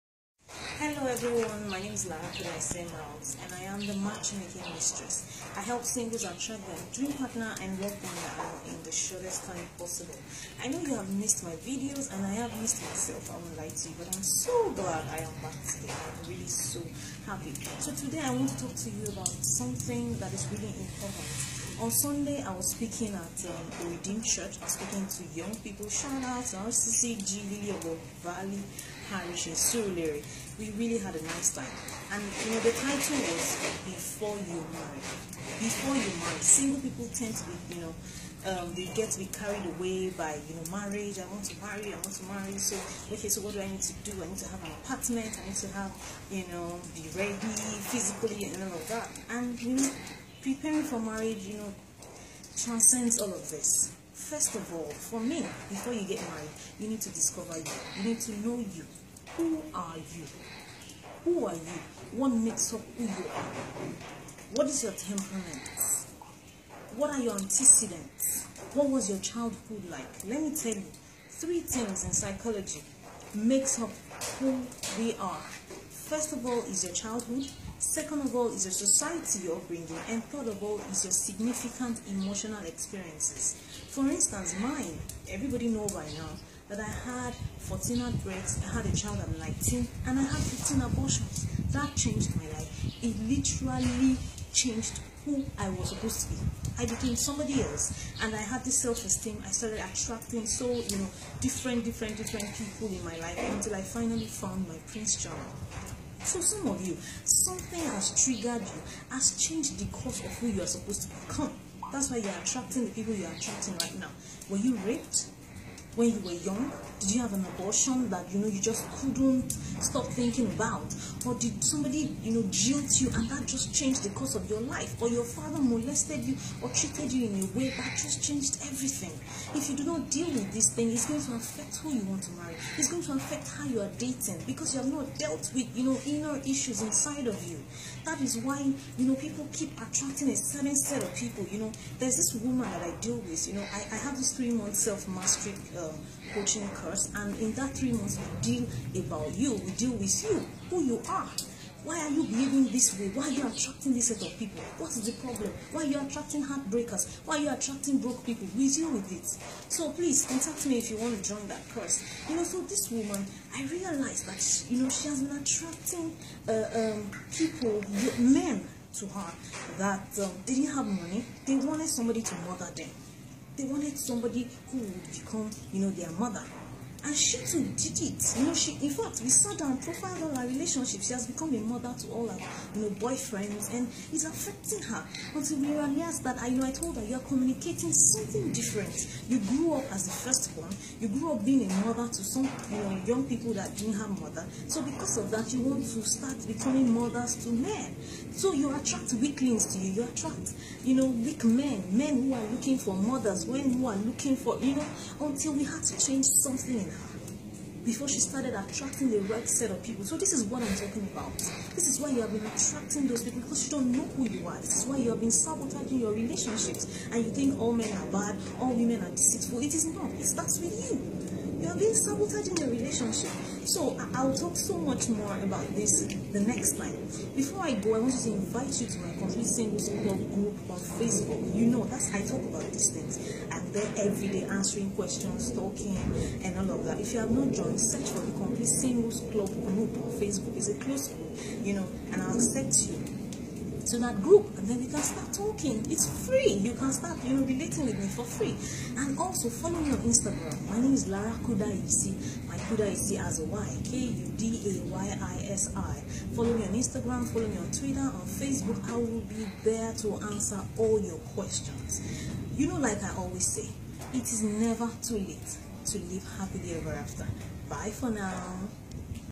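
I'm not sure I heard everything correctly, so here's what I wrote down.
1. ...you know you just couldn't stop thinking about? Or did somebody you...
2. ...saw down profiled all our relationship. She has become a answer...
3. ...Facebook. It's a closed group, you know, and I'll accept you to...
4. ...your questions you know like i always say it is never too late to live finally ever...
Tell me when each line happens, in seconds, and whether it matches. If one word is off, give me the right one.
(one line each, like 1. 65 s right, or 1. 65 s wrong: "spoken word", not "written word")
1. 118 s right
2. 179 s wrong: "mother", not "answer"
3. 240 s right
4. 261 s wrong: "happily", not "finally".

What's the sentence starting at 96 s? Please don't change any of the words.
I became somebody else, and I had this self-esteem.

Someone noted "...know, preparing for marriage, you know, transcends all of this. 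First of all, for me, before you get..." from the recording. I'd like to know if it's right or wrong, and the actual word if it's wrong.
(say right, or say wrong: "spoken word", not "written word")
right.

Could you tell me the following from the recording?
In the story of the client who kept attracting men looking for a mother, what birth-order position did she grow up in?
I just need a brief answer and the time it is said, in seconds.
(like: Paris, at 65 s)
Firstborn, at 190 s.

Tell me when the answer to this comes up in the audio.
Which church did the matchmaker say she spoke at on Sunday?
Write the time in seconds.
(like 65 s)
23 s.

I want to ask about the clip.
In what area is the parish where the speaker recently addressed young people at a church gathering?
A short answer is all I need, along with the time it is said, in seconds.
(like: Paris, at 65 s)
Surulere, at 29 s.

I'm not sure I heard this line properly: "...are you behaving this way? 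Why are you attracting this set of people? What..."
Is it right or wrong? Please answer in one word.
right.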